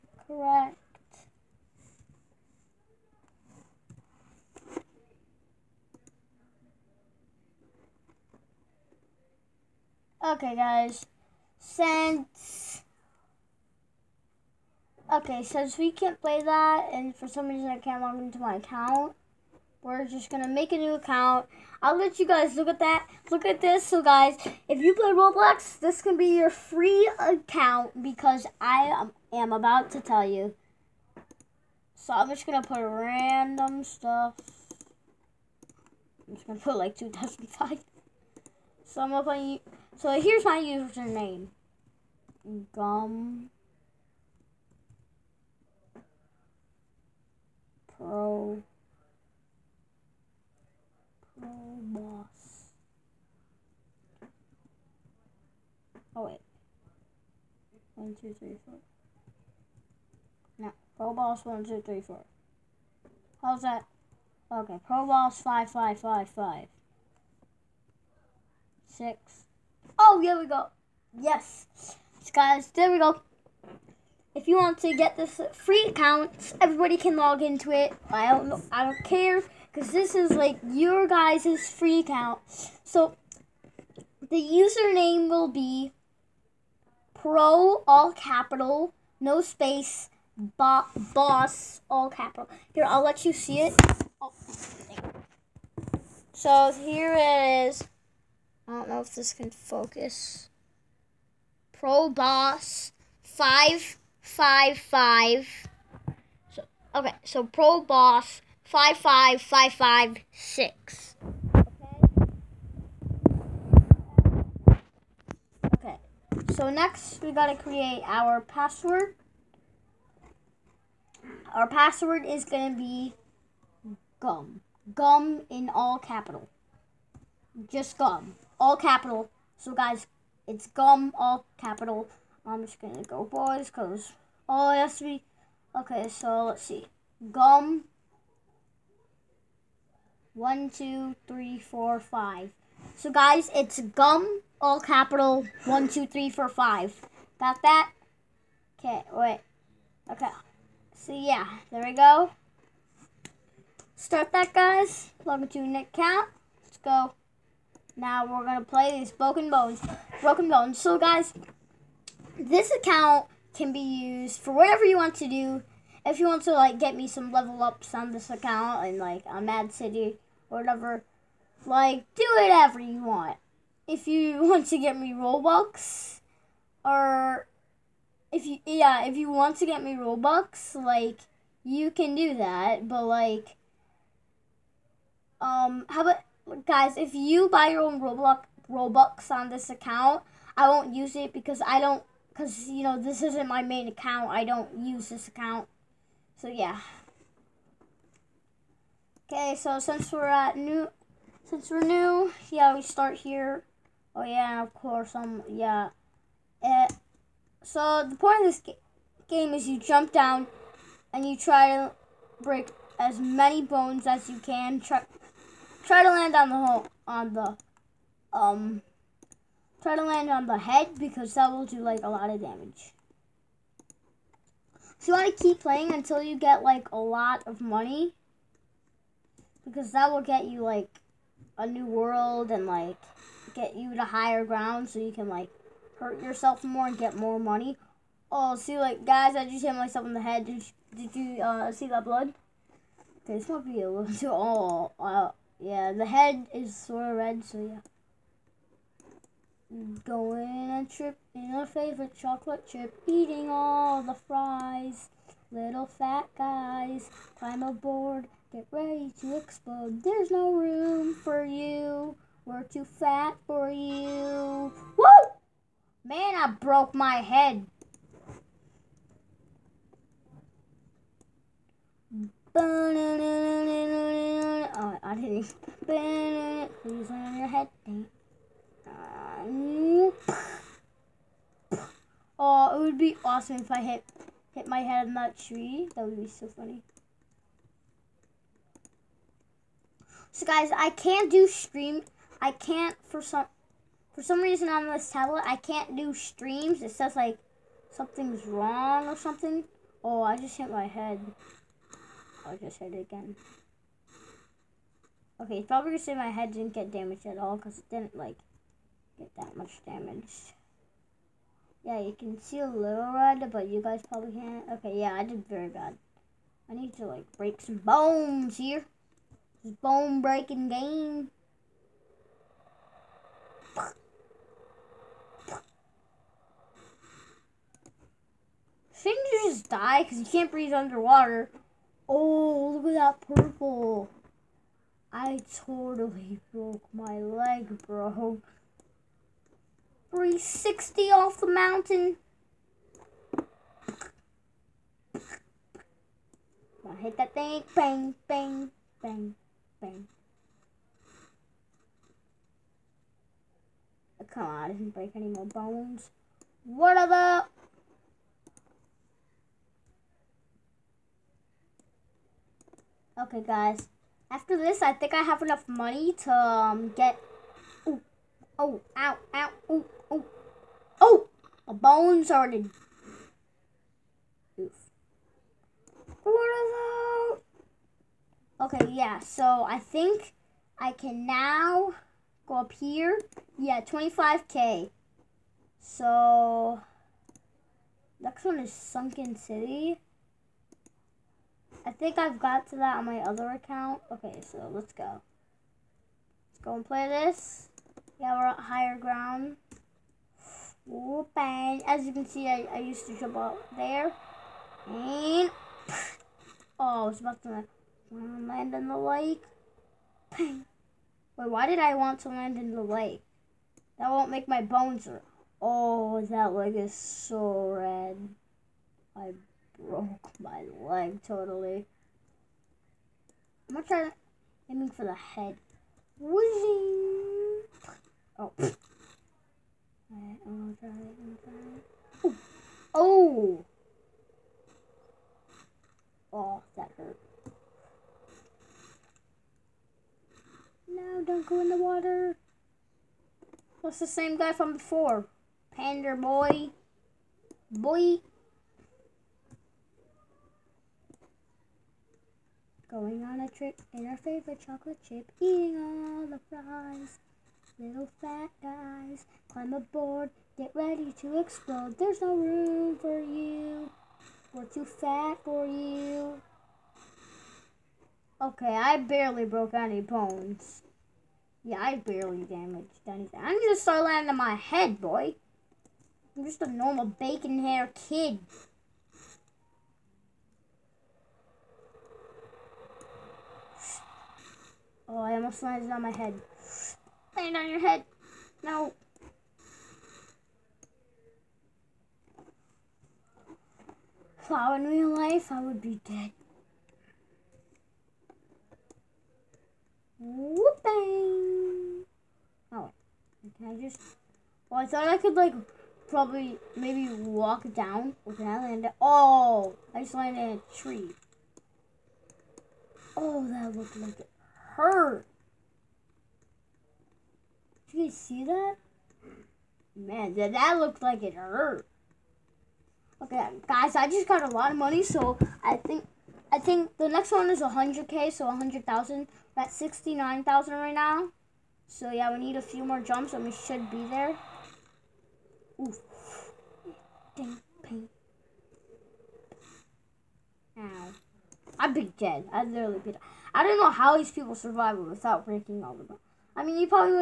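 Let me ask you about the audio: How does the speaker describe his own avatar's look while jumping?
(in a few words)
Bacon hair kid.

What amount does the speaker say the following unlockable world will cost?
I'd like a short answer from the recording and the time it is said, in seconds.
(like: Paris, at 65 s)
100,000, at 528 s.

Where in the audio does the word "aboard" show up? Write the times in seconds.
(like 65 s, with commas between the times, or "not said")
257 s, 459 s.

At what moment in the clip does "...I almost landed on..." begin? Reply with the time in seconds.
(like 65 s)
485 s.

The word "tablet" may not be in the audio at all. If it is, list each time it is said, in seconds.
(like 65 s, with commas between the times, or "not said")
295 s.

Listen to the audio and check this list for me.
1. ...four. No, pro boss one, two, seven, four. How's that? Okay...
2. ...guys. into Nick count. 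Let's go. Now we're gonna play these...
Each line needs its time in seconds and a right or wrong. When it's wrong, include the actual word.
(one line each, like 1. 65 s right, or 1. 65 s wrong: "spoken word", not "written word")
1. 58 s wrong: "three", not "seven"
2. 154 s right.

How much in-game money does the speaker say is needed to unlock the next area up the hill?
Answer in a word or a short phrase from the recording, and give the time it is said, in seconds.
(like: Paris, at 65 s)
25k, at 383 s.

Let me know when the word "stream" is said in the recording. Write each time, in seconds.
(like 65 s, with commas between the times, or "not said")
291 s, 296 s.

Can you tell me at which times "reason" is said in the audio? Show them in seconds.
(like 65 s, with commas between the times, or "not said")
17 s, 294 s.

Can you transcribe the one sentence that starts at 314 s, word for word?
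Okay, yeah, I did very bad.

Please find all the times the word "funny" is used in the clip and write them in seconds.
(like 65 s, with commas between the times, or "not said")
286 s.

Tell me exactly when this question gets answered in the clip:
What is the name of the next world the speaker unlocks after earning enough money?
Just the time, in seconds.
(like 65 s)
388 s.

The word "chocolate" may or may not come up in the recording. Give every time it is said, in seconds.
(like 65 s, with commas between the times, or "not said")
252 s, 454 s.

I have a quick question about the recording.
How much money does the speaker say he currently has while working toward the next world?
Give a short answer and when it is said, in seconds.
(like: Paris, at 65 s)
69,000, at 529 s.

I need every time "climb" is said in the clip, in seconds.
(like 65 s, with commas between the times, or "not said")
257 s, 459 s.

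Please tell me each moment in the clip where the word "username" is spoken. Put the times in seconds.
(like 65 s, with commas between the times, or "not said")
40 s, 84 s.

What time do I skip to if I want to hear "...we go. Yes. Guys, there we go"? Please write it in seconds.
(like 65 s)
70 s.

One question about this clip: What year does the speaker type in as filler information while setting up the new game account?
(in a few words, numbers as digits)
2005.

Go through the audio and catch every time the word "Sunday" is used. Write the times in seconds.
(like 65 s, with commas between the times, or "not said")
not said.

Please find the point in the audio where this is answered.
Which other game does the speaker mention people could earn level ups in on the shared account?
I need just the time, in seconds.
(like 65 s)
169 s.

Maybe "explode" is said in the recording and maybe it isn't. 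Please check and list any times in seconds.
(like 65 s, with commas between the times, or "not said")
259 s, 461 s.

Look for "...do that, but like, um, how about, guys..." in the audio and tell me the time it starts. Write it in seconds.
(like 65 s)
182 s.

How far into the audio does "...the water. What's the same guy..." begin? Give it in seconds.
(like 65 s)
441 s.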